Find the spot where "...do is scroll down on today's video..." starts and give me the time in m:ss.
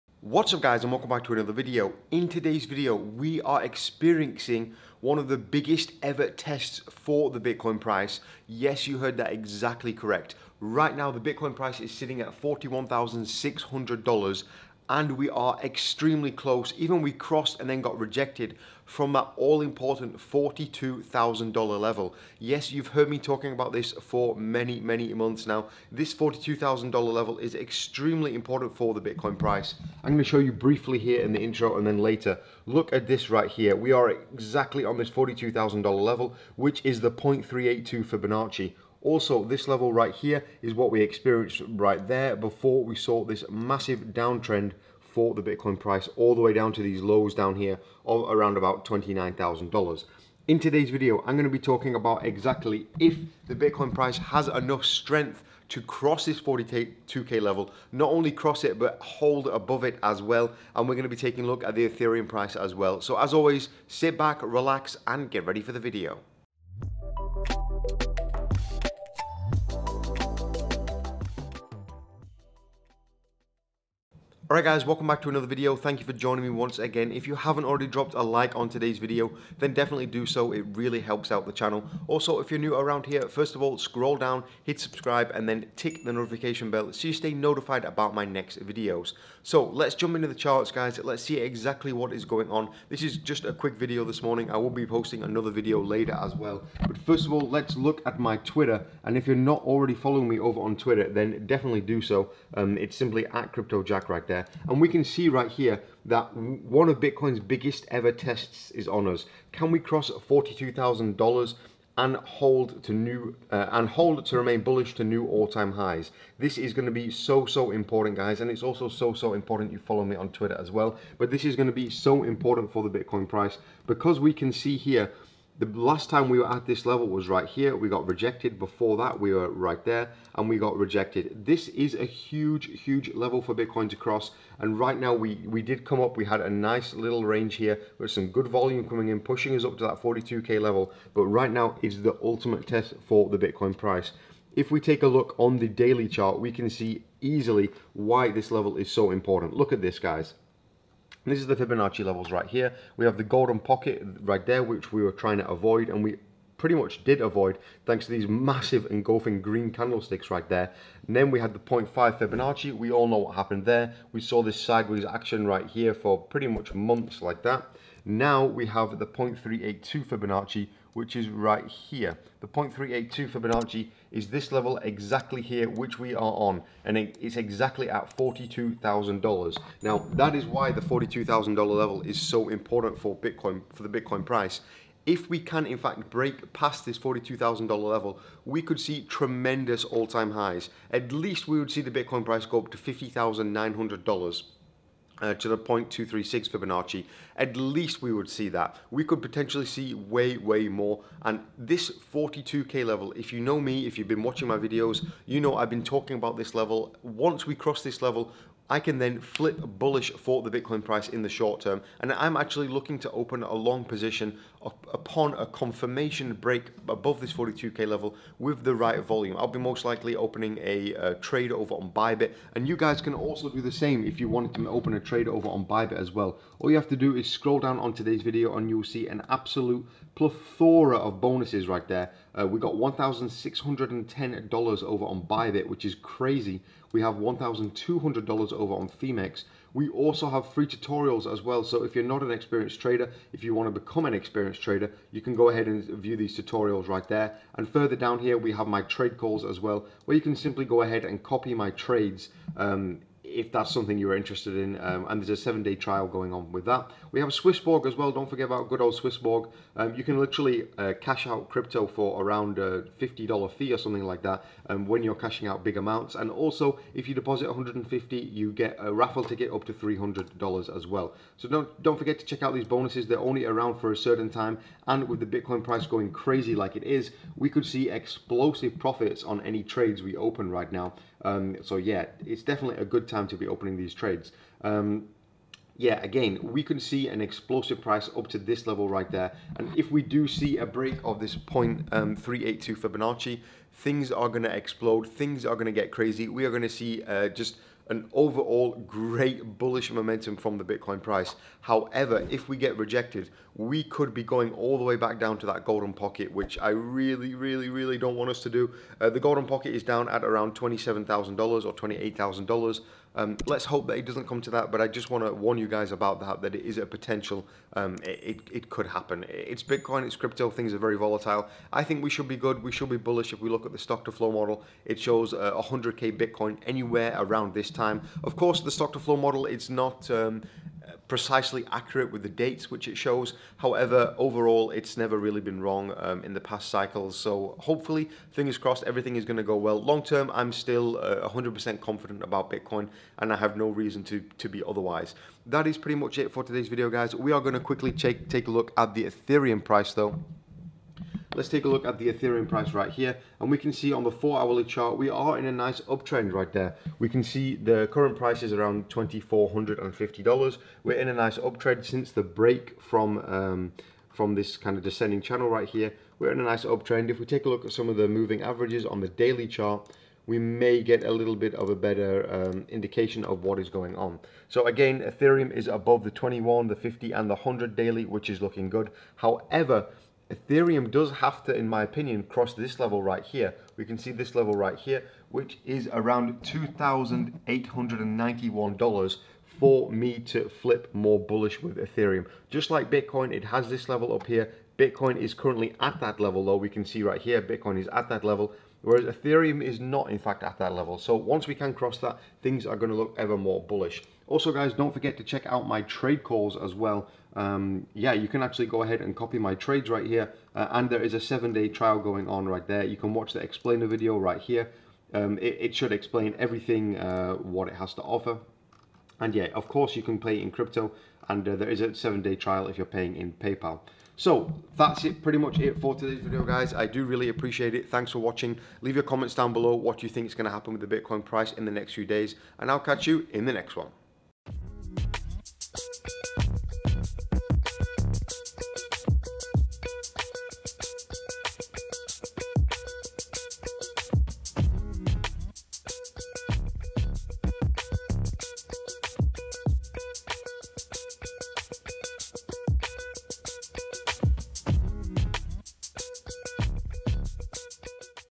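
3:46.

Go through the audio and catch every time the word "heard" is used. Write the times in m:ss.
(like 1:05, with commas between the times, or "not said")
0:08, 0:22.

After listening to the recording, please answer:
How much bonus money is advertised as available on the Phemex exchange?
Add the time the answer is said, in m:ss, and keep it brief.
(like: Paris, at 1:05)
$1,200, at 3:57.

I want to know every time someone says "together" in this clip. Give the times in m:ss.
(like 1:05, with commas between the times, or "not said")
not said.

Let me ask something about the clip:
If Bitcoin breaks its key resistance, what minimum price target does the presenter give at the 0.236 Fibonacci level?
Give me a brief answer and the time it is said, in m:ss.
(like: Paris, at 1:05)
$50,900, at 3:12.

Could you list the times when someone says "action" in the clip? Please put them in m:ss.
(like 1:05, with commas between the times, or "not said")
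2:45.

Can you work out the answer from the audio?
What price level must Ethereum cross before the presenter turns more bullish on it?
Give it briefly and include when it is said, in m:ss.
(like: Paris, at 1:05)
$2,891, at 6:26.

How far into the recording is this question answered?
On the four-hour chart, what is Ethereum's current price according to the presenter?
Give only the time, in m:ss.
5:58.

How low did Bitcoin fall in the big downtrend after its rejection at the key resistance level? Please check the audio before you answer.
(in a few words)
$29,000.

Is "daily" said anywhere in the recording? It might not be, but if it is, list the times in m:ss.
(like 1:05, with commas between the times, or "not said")
2:25, 6:09, 6:17.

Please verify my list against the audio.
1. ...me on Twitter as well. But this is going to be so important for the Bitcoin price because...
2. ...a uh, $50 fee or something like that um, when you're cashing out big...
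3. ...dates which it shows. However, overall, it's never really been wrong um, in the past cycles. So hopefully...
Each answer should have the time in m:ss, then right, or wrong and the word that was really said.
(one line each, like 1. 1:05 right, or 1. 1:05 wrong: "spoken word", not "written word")
1. 2:00 right
2. 4:22 right
3. 5:32 right.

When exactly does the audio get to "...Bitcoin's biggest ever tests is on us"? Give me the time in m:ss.
1:46.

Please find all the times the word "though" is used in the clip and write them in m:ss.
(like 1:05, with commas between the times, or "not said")
5:49, 6:36.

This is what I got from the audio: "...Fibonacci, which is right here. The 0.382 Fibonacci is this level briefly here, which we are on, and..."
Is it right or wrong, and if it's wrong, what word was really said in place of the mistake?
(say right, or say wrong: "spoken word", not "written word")
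wrong: "exactly", not "briefly".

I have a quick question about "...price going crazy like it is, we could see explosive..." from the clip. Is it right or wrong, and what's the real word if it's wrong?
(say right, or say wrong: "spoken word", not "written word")
right.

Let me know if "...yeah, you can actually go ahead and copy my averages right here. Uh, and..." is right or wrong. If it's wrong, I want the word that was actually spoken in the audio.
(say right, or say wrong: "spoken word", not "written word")
wrong: "trades", not "averages".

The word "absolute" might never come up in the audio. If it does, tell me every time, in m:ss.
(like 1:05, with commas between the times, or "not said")
3:49.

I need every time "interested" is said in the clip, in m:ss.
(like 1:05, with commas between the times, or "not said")
4:14.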